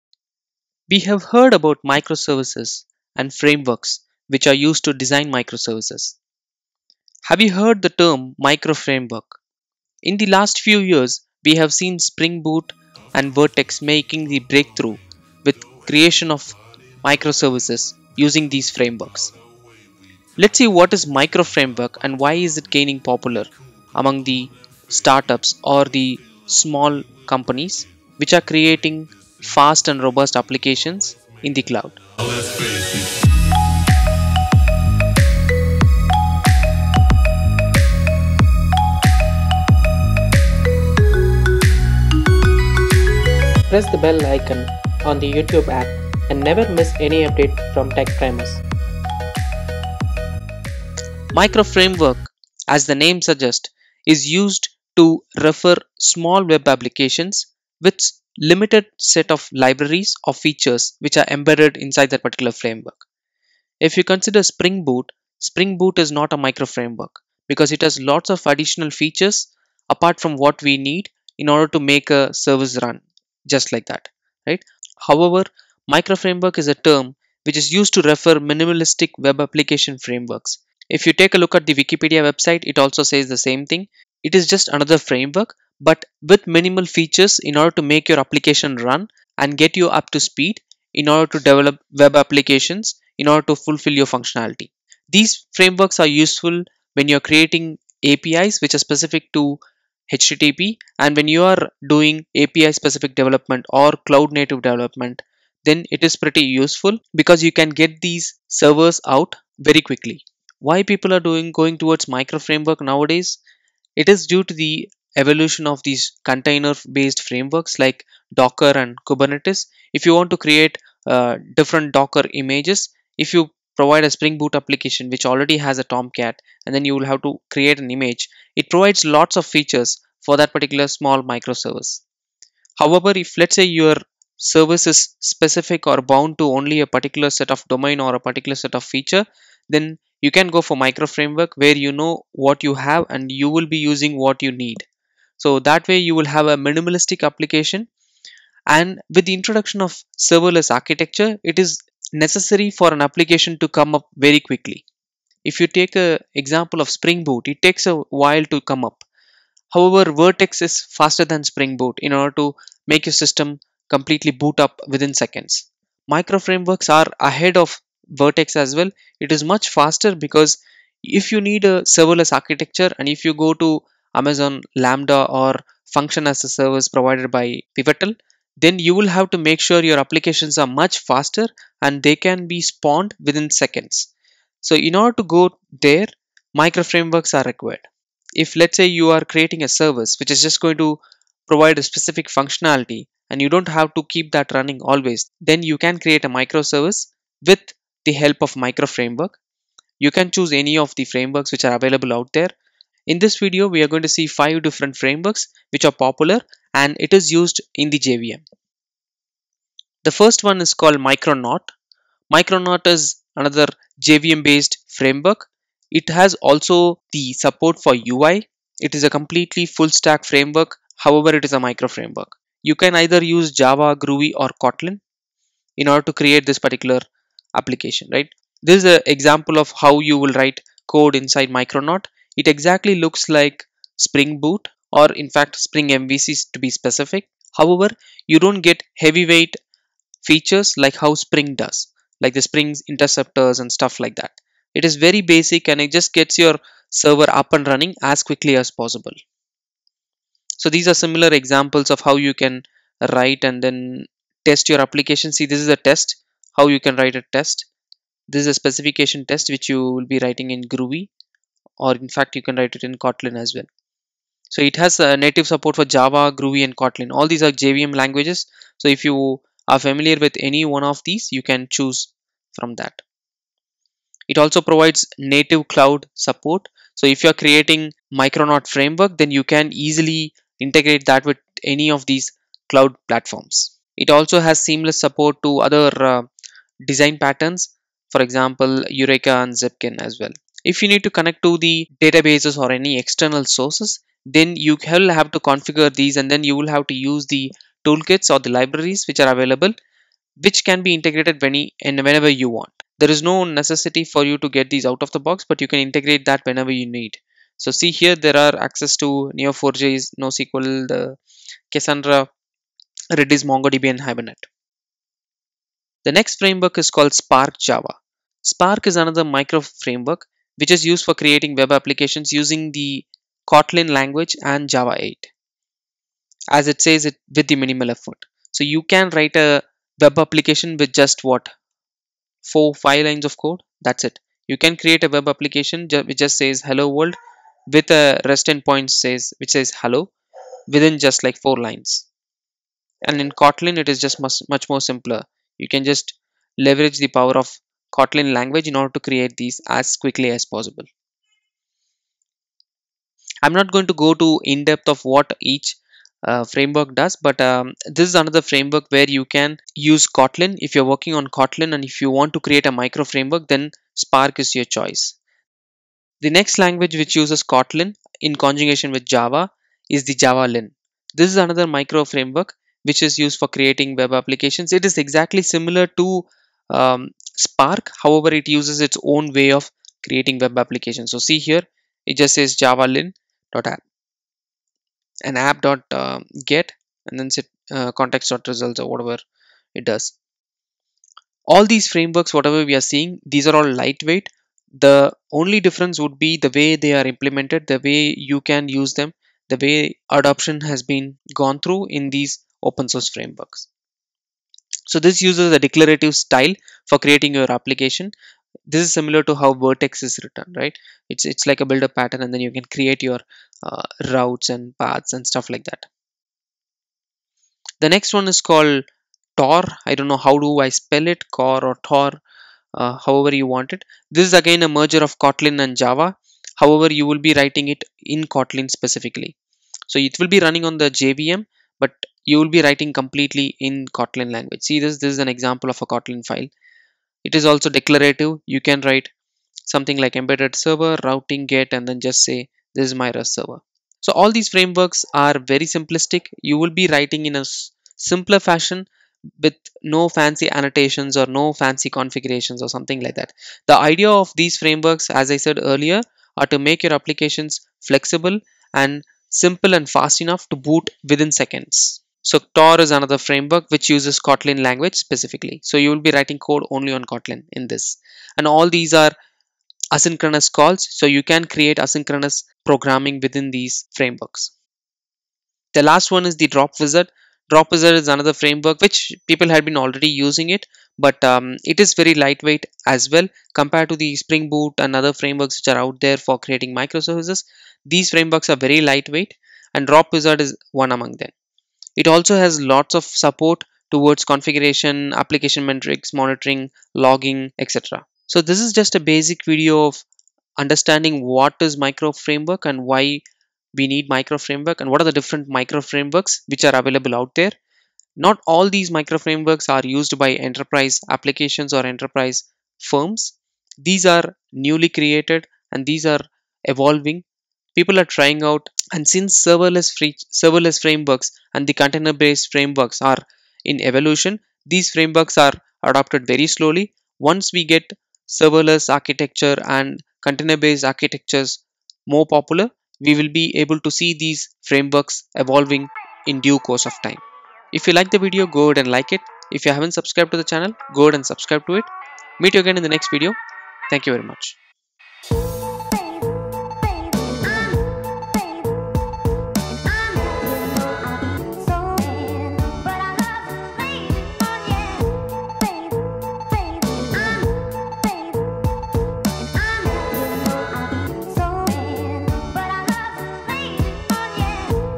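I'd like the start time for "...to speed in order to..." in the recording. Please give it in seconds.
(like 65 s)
90 s.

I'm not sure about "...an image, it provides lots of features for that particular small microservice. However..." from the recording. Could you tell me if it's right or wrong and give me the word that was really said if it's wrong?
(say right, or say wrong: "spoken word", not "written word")
right.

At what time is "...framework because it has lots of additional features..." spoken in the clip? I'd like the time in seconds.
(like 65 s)
66 s.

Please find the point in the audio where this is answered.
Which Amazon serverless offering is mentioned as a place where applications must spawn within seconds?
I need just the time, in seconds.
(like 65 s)
174 s.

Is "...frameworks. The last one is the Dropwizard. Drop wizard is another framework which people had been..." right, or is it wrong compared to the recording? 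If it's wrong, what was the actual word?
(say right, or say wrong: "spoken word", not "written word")
right.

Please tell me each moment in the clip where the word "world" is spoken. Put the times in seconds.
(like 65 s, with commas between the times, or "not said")
336 s.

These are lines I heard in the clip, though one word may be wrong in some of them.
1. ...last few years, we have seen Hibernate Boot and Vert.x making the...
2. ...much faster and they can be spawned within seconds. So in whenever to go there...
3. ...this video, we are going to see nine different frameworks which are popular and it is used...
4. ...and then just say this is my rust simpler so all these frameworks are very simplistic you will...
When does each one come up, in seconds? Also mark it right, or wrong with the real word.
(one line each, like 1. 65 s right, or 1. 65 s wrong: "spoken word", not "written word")
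1. 10 s wrong: "Spring", not "Hibernate"
2. 180 s wrong: "order", not "whenever"
3. 203 s wrong: "five", not "nine"
4. 441 s wrong: "server", not "simpler".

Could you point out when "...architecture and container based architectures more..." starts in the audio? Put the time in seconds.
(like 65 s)
528 s.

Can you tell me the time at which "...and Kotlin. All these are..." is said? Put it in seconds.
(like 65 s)
266 s.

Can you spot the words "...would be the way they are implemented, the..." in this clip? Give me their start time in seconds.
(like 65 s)
395 s.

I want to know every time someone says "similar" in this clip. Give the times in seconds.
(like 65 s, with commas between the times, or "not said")
250 s, 375 s, 408 s.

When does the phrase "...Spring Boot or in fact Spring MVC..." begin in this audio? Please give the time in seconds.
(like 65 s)
233 s.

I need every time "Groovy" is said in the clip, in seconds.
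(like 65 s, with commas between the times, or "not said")
223 s, 260 s, 266 s.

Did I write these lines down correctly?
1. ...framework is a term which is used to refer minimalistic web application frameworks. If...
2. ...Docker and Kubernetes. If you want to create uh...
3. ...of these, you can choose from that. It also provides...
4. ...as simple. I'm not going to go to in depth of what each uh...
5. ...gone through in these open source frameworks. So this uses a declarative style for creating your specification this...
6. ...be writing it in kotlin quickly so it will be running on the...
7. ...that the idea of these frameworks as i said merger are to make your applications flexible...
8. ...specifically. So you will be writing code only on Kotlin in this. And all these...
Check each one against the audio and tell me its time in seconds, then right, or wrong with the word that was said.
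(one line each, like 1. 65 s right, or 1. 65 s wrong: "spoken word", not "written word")
1. 76 s right
2. 118 s right
3. 270 s right
4. 350 s wrong: "possible", not "simple"
5. 401 s wrong: "application", not "specification"
6. 427 s wrong: "specifically", not "quickly"
7. 453 s wrong: "earlier", not "merger"
8. 464 s right.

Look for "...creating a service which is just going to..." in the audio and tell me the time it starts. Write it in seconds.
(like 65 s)
189 s.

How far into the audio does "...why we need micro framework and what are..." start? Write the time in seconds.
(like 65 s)
502 s.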